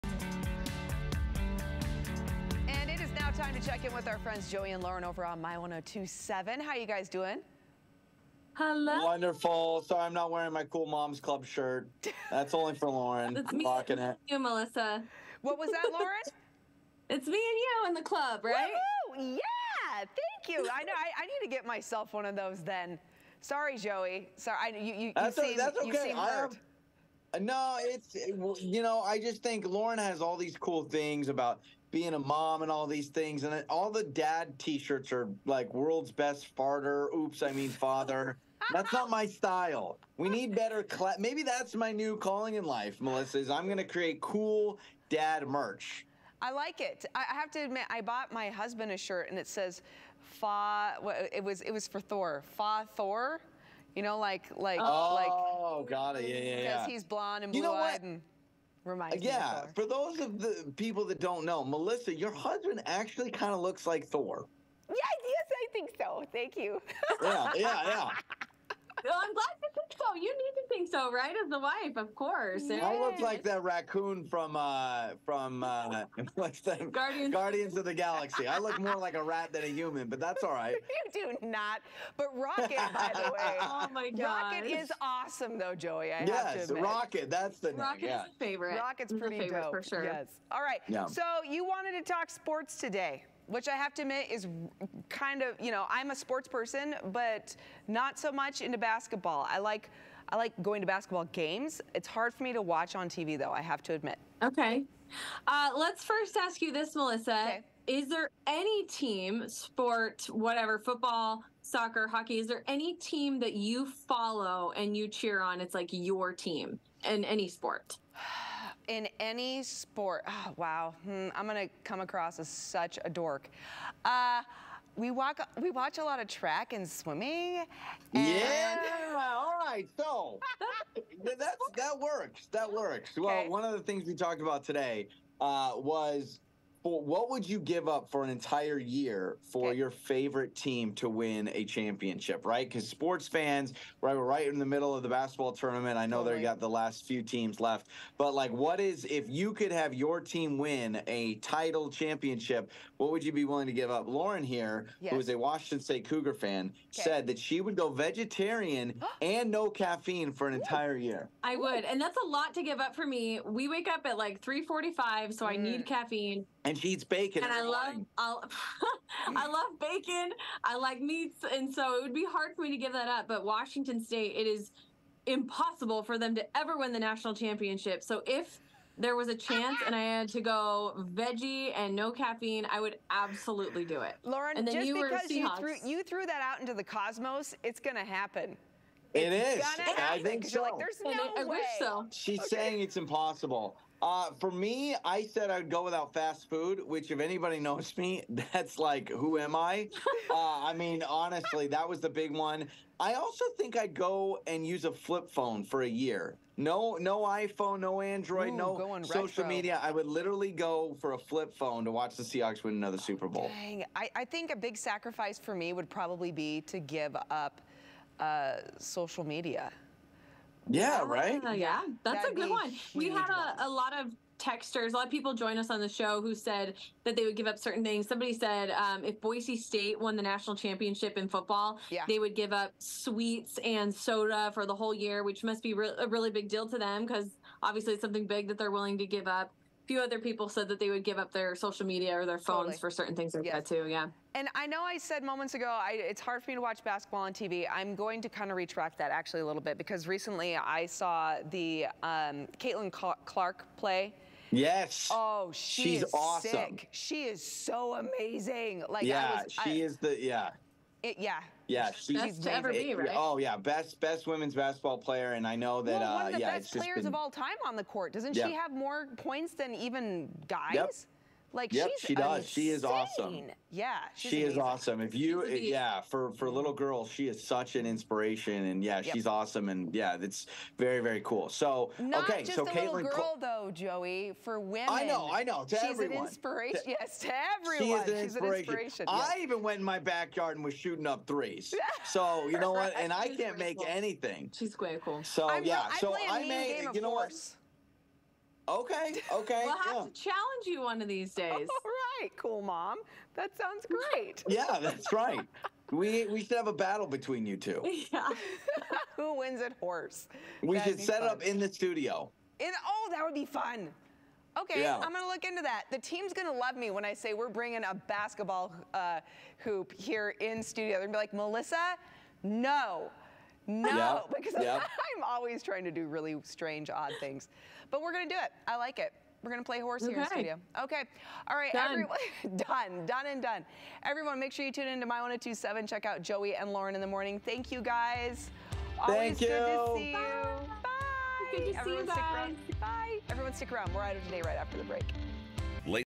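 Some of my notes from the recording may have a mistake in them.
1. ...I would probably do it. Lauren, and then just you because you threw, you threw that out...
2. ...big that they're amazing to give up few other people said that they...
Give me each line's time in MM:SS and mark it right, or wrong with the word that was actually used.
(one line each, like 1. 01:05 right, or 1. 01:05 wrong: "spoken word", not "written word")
1. 03:02 wrong: "absolutely", not "probably"
2. 03:58 wrong: "willing", not "amazing".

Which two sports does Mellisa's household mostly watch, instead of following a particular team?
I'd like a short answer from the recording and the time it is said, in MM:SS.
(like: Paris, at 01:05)
Track and swimming, at 02:06.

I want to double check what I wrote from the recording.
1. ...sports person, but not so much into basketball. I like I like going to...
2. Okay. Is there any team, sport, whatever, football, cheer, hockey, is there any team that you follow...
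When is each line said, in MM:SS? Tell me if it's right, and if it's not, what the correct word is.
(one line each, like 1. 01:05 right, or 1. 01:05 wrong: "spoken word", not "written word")
1. 01:36 right
2. 01:47 wrong: "soccer", not "cheer".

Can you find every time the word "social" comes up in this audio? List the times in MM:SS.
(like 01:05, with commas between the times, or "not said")
03:29, 03:38, 04:01.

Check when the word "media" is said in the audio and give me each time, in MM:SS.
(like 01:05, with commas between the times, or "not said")
03:29, 03:39, 04:01.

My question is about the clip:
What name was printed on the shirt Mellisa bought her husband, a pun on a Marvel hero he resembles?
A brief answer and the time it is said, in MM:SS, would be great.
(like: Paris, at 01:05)
Fa Thor, at 00:52.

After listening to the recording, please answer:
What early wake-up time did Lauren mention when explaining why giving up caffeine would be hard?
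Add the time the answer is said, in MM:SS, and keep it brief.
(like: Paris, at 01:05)
3:45, at 02:44.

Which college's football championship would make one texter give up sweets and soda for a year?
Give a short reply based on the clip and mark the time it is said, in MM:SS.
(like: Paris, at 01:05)
Boise State, at 03:49.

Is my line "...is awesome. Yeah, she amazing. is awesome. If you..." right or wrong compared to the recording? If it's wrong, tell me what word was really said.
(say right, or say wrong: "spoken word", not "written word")
right.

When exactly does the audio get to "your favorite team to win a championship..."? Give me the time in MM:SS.
02:19.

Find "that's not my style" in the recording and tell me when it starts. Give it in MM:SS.
00:38.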